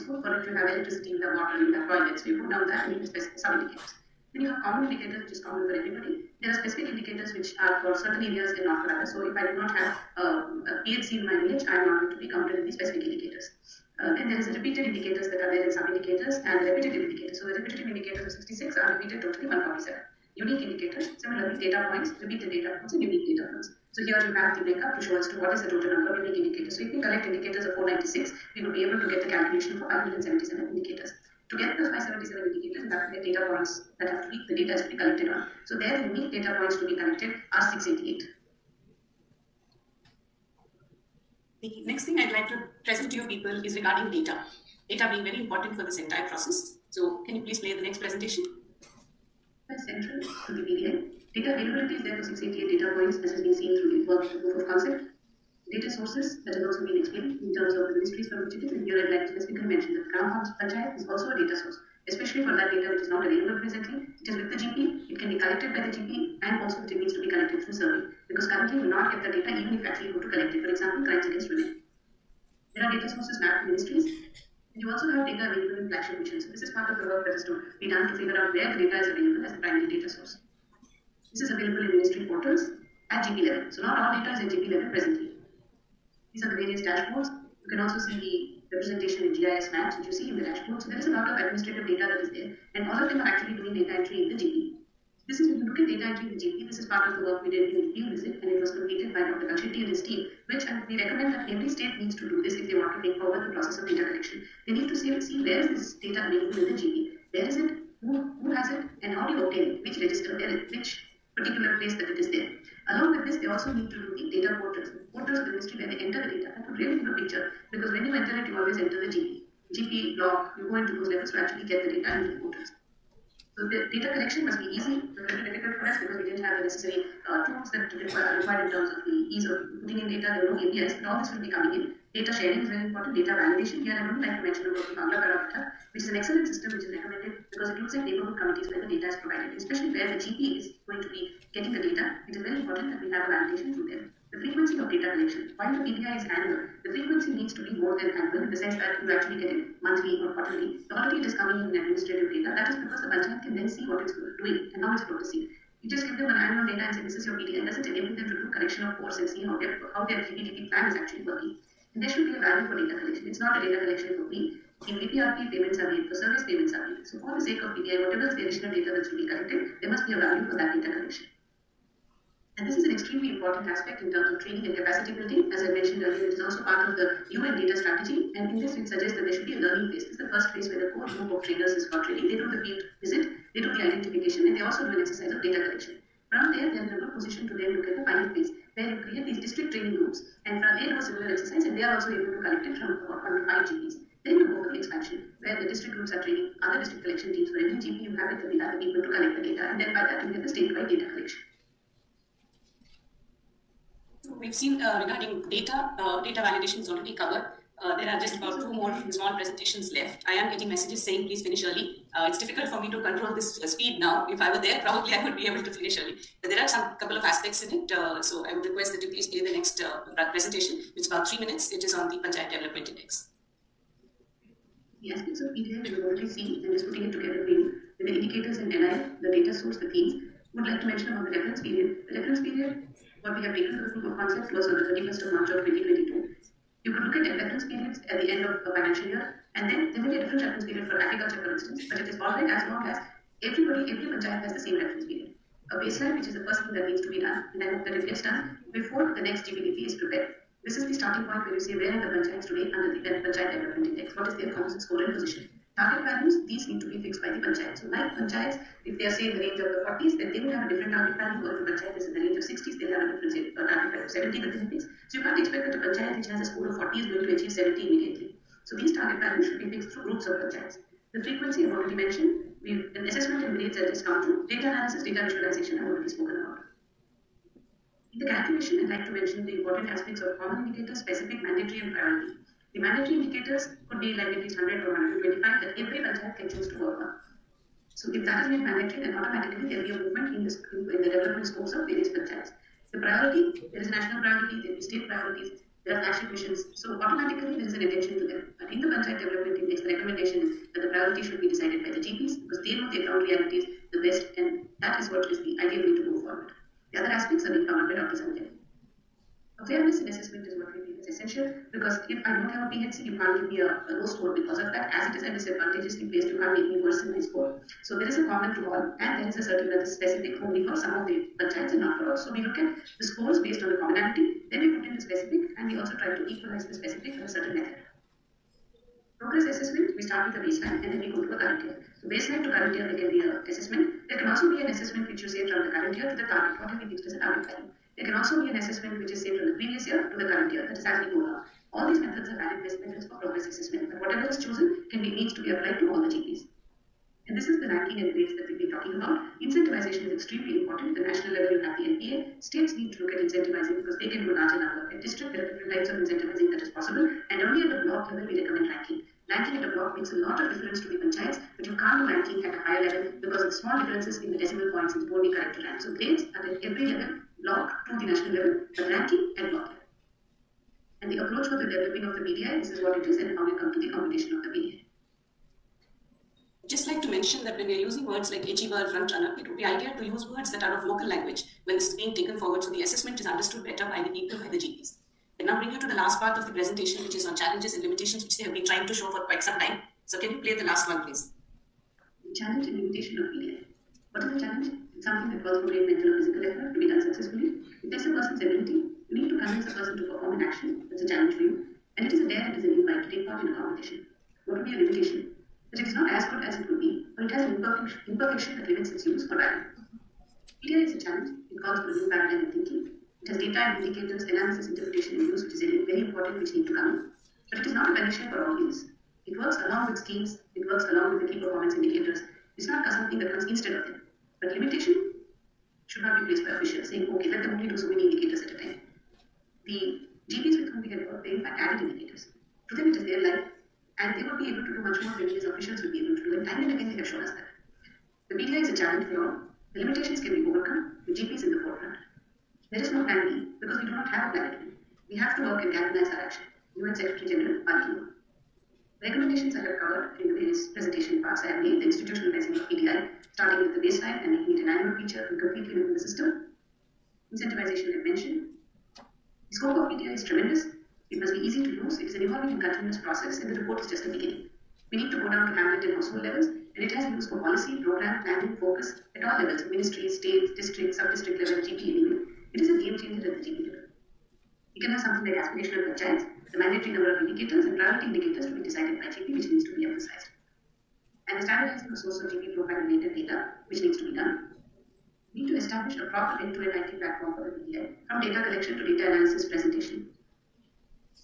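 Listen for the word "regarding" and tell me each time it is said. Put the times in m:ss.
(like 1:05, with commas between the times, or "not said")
0:43, 3:25.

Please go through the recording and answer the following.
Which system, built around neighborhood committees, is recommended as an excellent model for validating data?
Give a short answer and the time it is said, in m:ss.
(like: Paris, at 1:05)
Bangla Parameter, at 2:14.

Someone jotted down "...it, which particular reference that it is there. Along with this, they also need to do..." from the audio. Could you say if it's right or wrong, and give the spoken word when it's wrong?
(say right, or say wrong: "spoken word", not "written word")
wrong: "place", not "reference".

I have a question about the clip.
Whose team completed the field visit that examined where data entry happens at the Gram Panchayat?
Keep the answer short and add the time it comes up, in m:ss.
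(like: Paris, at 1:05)
Dr. Kalshetty, at 1:39.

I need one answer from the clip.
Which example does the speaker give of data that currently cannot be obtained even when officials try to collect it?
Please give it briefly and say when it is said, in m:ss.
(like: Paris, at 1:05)
Crimes against women, at 1:11.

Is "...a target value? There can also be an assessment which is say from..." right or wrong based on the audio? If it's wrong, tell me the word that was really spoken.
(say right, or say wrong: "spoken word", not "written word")
right.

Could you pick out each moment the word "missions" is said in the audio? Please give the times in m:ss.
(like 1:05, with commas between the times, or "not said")
1:16, 4:56.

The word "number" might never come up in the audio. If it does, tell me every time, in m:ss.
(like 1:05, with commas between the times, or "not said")
0:25, 5:54, 7:56.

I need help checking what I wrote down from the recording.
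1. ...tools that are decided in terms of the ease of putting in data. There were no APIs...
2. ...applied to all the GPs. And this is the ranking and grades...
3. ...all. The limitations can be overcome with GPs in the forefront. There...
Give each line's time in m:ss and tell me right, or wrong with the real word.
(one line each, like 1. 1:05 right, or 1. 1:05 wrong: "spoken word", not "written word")
1. 2:07 wrong: "required", not "decided"
2. 5:45 right
3. 7:19 right.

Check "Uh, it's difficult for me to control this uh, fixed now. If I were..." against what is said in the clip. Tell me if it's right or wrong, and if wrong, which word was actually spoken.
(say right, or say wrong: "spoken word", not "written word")
wrong: "speed", not "fixed".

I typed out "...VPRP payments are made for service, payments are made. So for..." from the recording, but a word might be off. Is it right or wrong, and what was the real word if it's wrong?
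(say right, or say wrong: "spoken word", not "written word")
right.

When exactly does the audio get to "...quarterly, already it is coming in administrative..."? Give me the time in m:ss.
2:30.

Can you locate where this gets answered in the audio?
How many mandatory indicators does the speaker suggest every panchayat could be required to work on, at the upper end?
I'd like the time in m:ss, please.
4:45.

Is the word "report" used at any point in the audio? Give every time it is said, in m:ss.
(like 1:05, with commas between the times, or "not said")
7:43.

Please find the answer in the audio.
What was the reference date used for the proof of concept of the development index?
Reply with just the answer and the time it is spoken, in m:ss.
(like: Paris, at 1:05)
31 March 2022, at 3:54.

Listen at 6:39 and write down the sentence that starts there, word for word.
You need to convince a person to perform an action.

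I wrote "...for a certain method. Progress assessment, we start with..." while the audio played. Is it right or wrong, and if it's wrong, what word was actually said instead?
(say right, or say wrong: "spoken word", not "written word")
right.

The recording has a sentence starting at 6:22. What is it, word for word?
So the assessment is understood better by the people, by the GPs.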